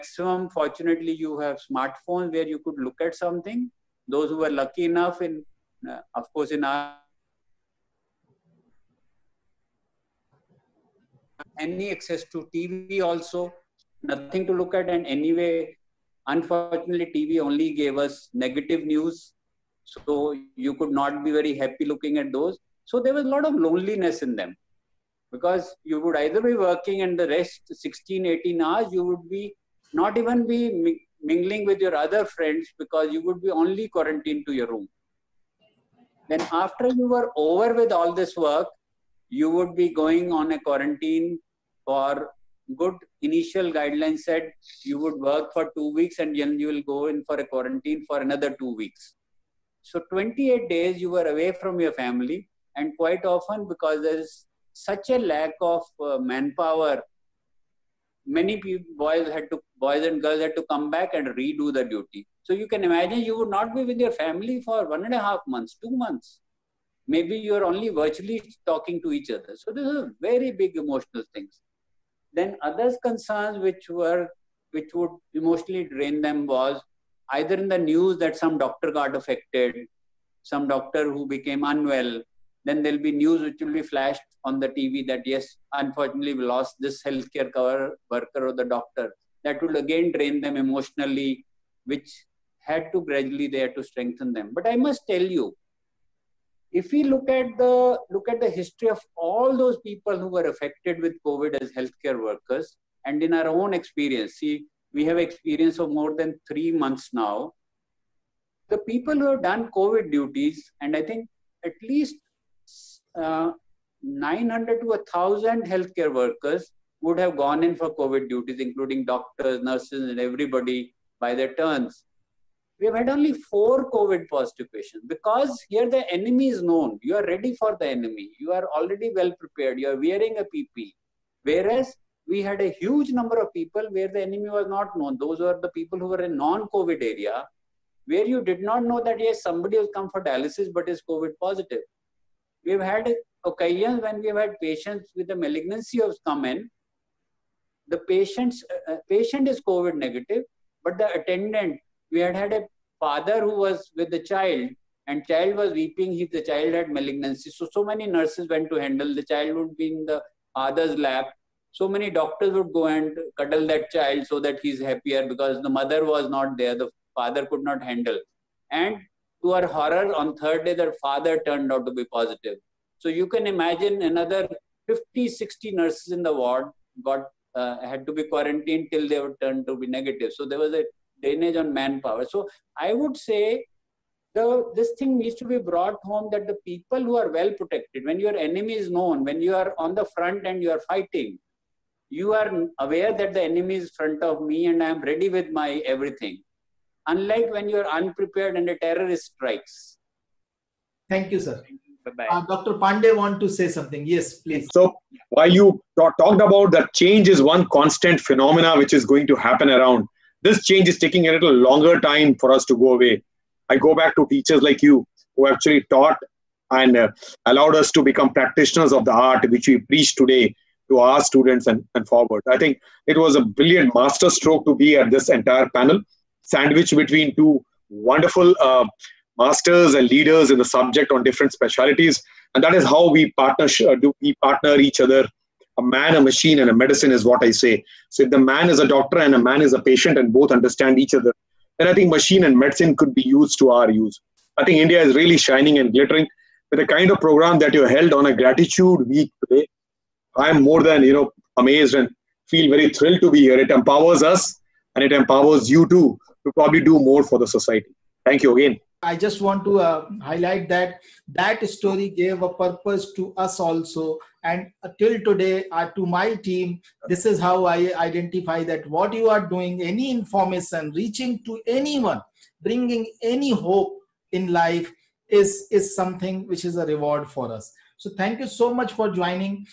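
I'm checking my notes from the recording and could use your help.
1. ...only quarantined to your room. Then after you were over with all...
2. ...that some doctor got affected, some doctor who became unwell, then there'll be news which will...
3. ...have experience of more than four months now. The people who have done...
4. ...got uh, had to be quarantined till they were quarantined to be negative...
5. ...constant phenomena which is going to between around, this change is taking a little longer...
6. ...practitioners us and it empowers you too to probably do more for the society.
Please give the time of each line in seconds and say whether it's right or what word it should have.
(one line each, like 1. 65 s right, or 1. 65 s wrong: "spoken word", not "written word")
1. 33 s right
2. 78 s right
3. 105 s wrong: "three", not "four"
4. 177 s wrong: "turned", not "quarantined"
5. 207 s wrong: "happen", not "between"
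6. 253 s wrong: "empowers", not "practitioners".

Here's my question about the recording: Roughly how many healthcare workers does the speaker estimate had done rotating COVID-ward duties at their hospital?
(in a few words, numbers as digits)
900 to 1,000.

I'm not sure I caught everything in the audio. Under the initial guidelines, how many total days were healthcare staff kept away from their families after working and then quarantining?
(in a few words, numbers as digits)
28 days.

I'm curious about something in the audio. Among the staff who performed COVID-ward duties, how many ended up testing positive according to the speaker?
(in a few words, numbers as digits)
4.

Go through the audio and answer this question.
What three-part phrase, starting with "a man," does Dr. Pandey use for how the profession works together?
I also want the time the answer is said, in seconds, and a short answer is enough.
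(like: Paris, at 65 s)
A man, a machine, and a medicine, at 235 s.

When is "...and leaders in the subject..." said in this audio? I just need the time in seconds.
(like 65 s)
229 s.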